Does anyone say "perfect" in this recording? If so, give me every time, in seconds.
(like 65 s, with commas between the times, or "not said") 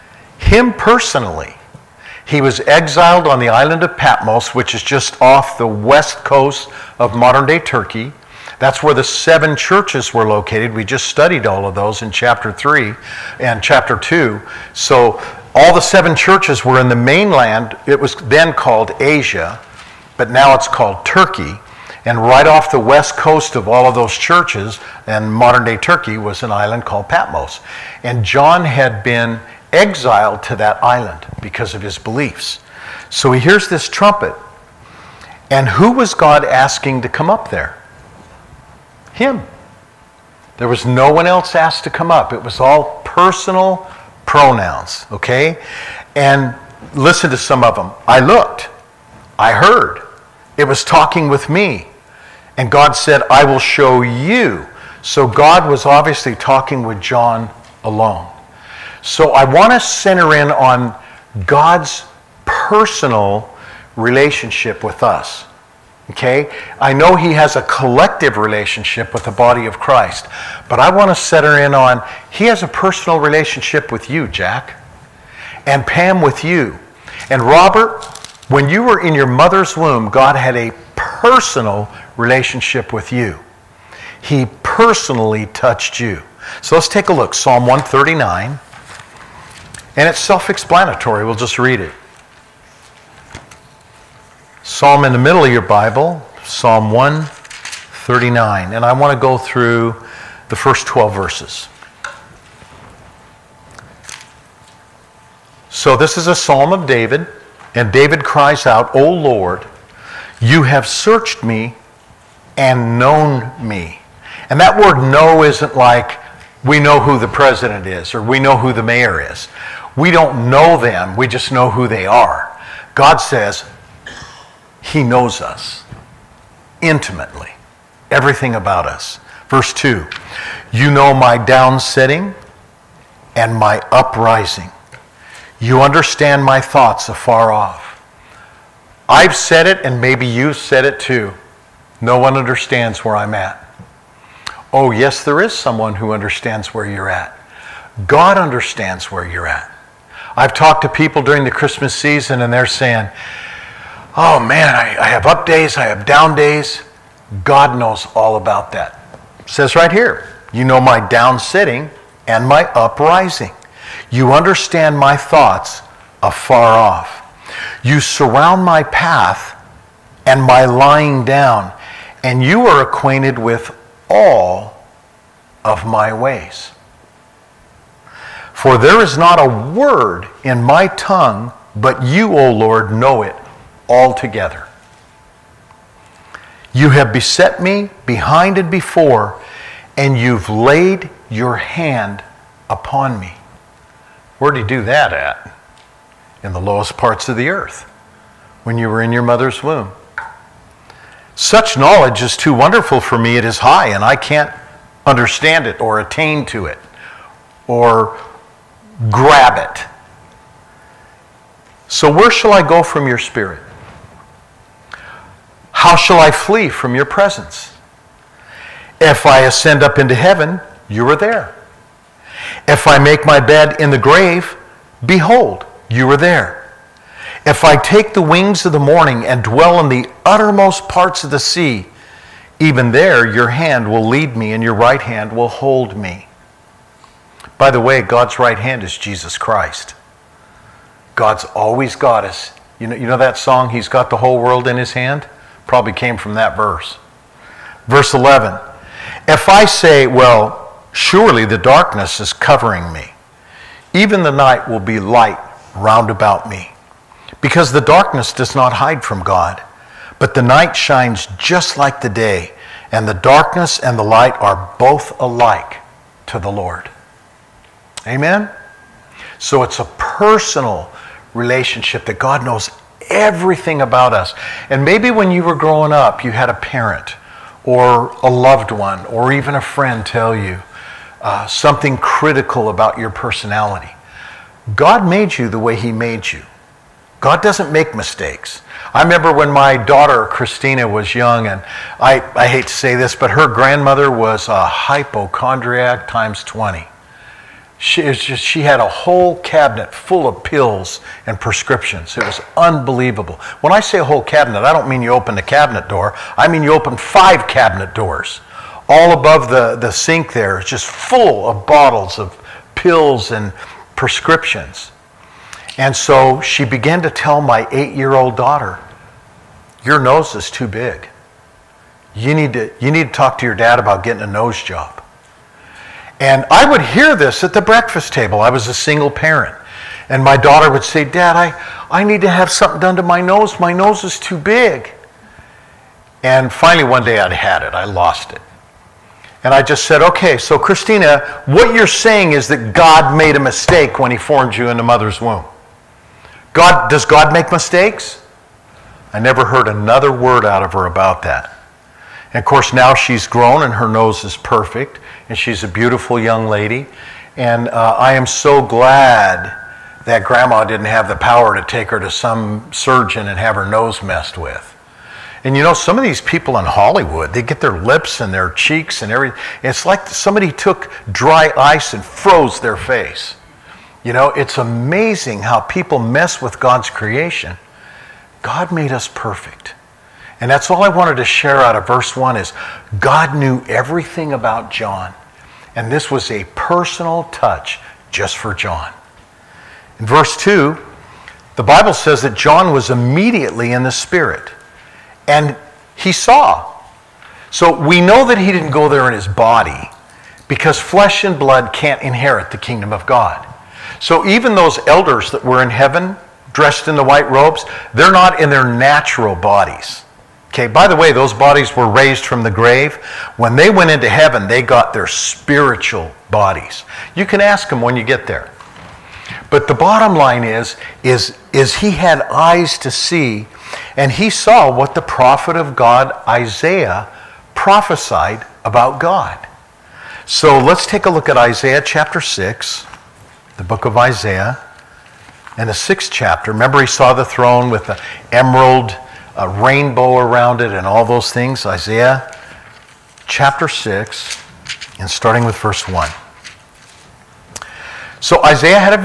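354 s, 379 s.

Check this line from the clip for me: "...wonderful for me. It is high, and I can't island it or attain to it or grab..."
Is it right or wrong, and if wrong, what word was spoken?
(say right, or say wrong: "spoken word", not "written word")
wrong: "understand", not "island".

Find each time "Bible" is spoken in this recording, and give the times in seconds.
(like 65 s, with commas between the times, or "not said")
95 s, 391 s.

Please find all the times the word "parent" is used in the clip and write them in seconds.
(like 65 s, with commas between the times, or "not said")
276 s, 329 s.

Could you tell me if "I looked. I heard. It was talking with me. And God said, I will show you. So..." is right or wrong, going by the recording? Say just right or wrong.
right.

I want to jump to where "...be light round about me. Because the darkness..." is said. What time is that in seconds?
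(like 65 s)
254 s.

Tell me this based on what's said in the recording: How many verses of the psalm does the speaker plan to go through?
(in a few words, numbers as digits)
12.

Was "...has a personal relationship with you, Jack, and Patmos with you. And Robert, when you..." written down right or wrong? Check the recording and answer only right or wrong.
wrong.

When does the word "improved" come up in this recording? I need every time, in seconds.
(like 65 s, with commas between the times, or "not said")
not said.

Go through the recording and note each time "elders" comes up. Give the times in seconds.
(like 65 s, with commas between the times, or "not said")
404 s.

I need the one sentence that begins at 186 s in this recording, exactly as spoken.
You have beset me behind and before, and you've laid your hand upon me.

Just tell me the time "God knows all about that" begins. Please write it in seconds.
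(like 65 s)
157 s.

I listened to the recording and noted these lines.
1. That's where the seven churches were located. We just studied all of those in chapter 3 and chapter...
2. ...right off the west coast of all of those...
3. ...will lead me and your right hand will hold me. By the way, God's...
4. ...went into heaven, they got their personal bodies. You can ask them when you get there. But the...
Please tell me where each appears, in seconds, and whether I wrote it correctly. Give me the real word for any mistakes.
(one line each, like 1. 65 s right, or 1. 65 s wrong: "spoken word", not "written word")
1. 8 s right
2. 22 s right
3. 233 s right
4. 413 s wrong: "spiritual", not "personal".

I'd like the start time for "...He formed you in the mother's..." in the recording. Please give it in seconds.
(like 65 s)
344 s.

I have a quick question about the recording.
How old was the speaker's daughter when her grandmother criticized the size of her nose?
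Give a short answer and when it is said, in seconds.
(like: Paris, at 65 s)
8, at 317 s.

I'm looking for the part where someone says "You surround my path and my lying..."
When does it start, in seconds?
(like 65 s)
167 s.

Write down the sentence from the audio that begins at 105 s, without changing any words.
So, this is a psalm of David, and David cries out, O Lord, you have searched me and known me.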